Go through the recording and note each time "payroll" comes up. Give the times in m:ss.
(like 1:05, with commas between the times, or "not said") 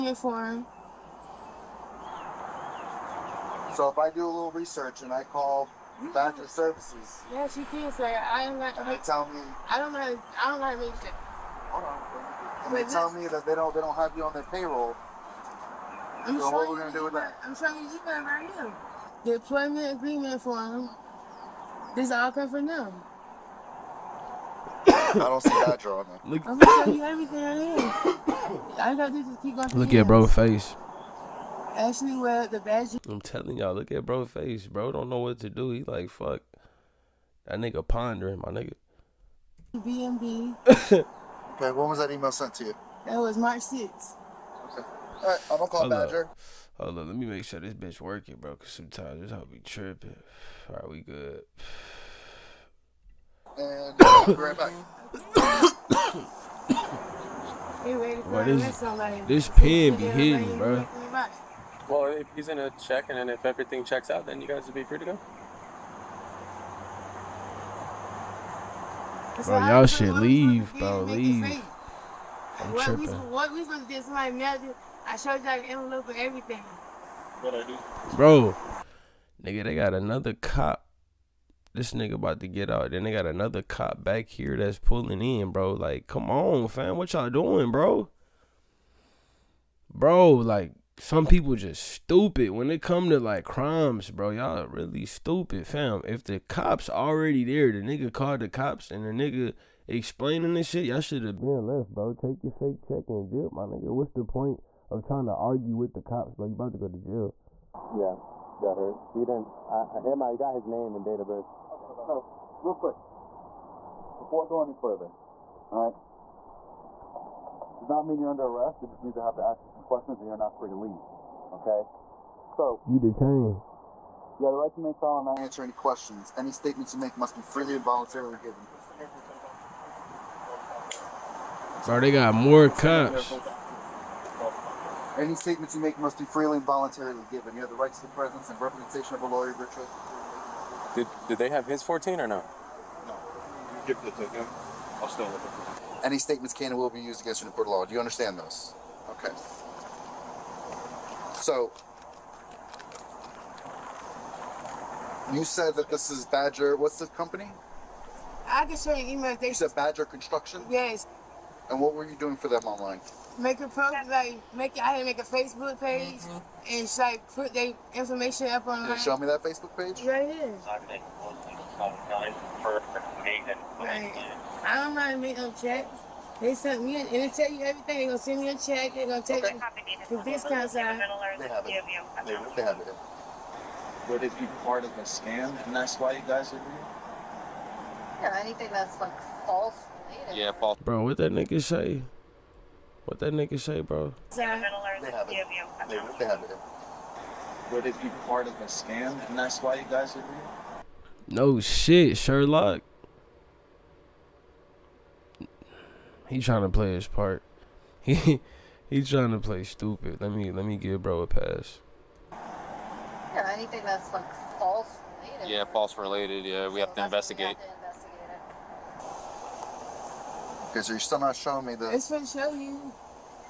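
0:14.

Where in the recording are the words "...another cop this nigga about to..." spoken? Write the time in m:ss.
1:19.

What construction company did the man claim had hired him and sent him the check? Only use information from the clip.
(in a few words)
Badger Construction.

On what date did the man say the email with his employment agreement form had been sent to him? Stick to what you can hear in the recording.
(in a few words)
March 6th.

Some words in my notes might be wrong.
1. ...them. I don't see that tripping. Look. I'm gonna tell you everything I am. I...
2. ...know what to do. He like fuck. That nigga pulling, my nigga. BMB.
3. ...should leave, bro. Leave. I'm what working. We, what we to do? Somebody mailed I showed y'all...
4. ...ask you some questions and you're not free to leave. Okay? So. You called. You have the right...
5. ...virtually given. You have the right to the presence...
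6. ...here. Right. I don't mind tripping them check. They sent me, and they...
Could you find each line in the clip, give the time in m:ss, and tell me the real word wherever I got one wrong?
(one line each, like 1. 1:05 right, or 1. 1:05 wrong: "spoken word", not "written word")
1. 0:22 wrong: "drawing", not "tripping"
2. 0:35 wrong: "pondering", not "pulling"
3. 1:09 wrong: "tripping", not "working"
4. 1:59 wrong: "detained", not "called"
5. 2:16 wrong: "voluntarily", not "virtually"
6. 2:50 wrong: "making", not "tripping".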